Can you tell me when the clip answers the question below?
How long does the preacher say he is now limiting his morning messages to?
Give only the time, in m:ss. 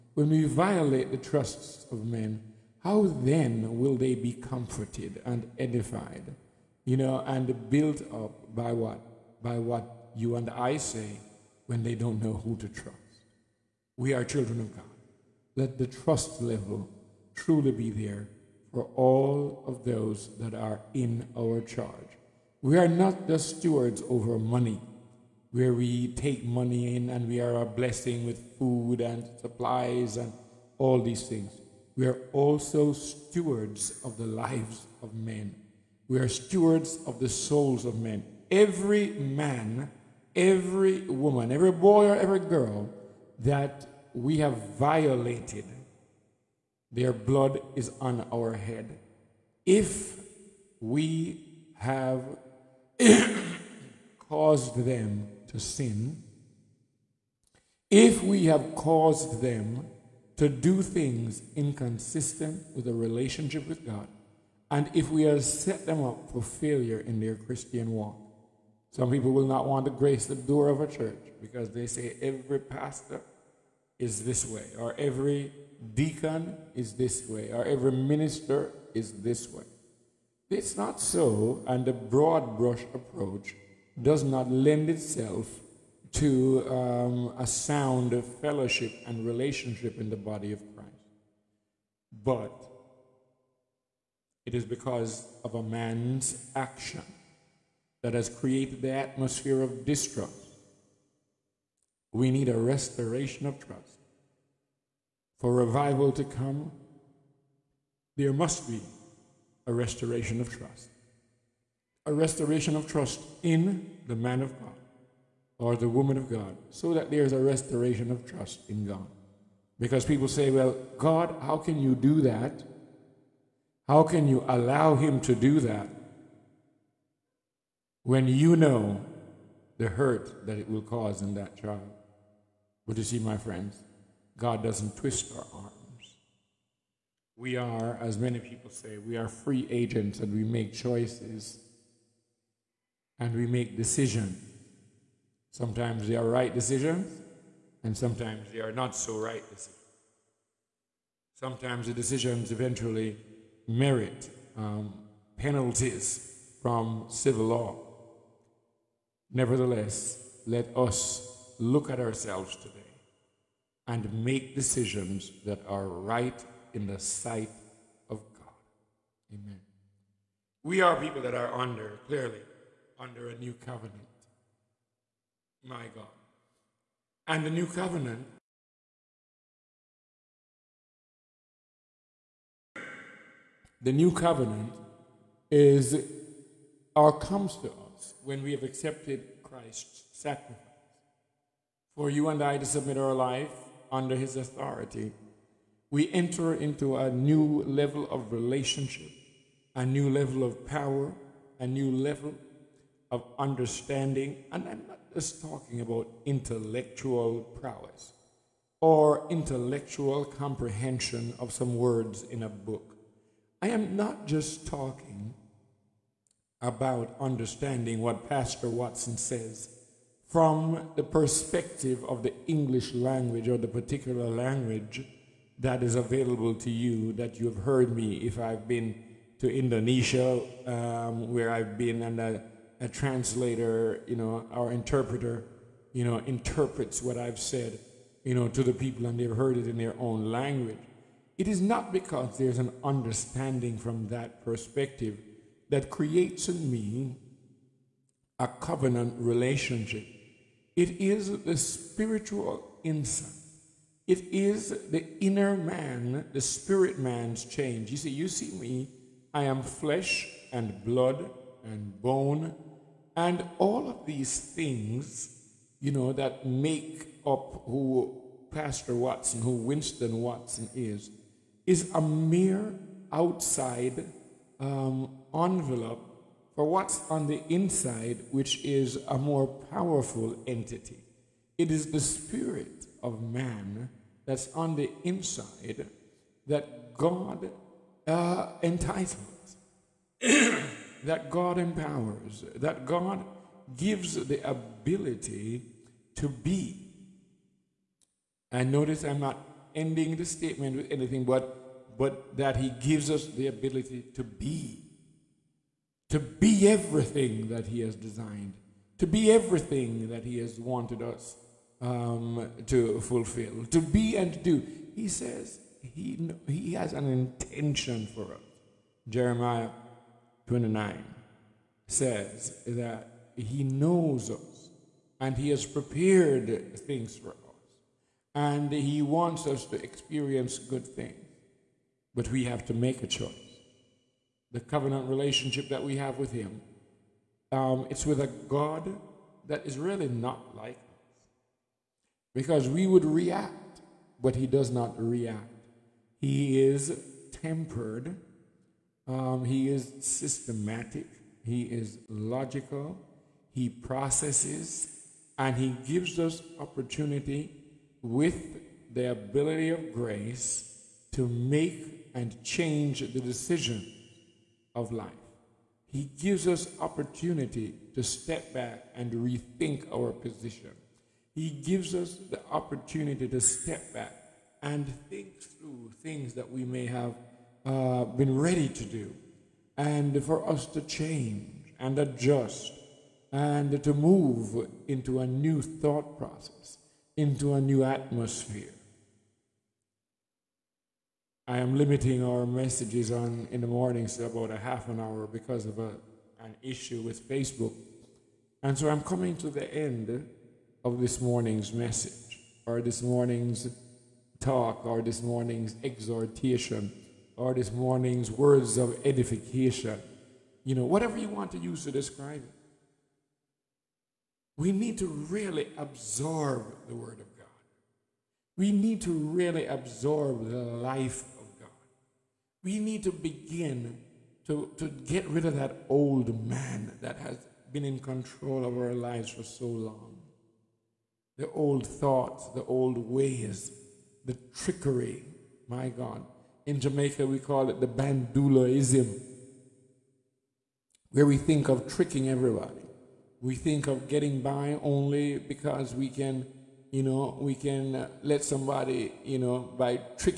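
6:34.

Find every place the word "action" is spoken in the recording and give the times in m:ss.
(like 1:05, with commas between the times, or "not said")
1:36.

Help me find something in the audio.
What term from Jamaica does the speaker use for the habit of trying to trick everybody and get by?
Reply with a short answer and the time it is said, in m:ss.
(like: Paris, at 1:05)
bandulaism, at 7:17.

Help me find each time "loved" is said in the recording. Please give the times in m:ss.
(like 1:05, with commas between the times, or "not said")
not said.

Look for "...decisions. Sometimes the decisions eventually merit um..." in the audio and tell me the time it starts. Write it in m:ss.
2:29.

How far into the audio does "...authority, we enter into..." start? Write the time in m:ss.
3:14.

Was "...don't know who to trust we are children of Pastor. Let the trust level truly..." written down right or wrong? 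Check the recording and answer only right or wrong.
wrong.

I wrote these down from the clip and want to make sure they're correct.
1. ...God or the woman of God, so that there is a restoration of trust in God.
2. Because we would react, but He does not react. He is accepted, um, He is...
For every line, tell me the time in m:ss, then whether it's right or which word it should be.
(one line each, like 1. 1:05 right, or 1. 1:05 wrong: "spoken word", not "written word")
1. 1:54 right
2. 5:42 wrong: "tempered", not "accepted".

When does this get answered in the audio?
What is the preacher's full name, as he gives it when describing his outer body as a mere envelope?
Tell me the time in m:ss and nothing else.
4:29.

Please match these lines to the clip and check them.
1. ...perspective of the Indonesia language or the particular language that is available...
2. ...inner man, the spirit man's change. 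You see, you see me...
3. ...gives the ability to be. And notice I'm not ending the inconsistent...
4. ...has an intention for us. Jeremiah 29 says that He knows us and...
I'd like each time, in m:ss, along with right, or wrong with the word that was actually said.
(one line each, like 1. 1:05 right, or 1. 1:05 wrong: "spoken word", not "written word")
1. 3:41 wrong: "English", not "Indonesia"
2. 4:15 right
3. 4:53 wrong: "statement", not "inconsistent"
4. 5:16 right.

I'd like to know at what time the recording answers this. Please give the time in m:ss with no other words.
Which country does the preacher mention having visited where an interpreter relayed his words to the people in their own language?
3:49.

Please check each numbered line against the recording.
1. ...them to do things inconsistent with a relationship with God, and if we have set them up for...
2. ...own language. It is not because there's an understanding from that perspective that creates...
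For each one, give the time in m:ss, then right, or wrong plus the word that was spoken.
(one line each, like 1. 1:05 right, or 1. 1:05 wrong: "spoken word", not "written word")
1. 0:59 right
2. 3:59 right.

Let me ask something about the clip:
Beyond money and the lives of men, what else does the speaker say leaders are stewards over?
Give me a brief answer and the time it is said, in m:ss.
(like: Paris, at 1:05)
souls of men, at 0:37.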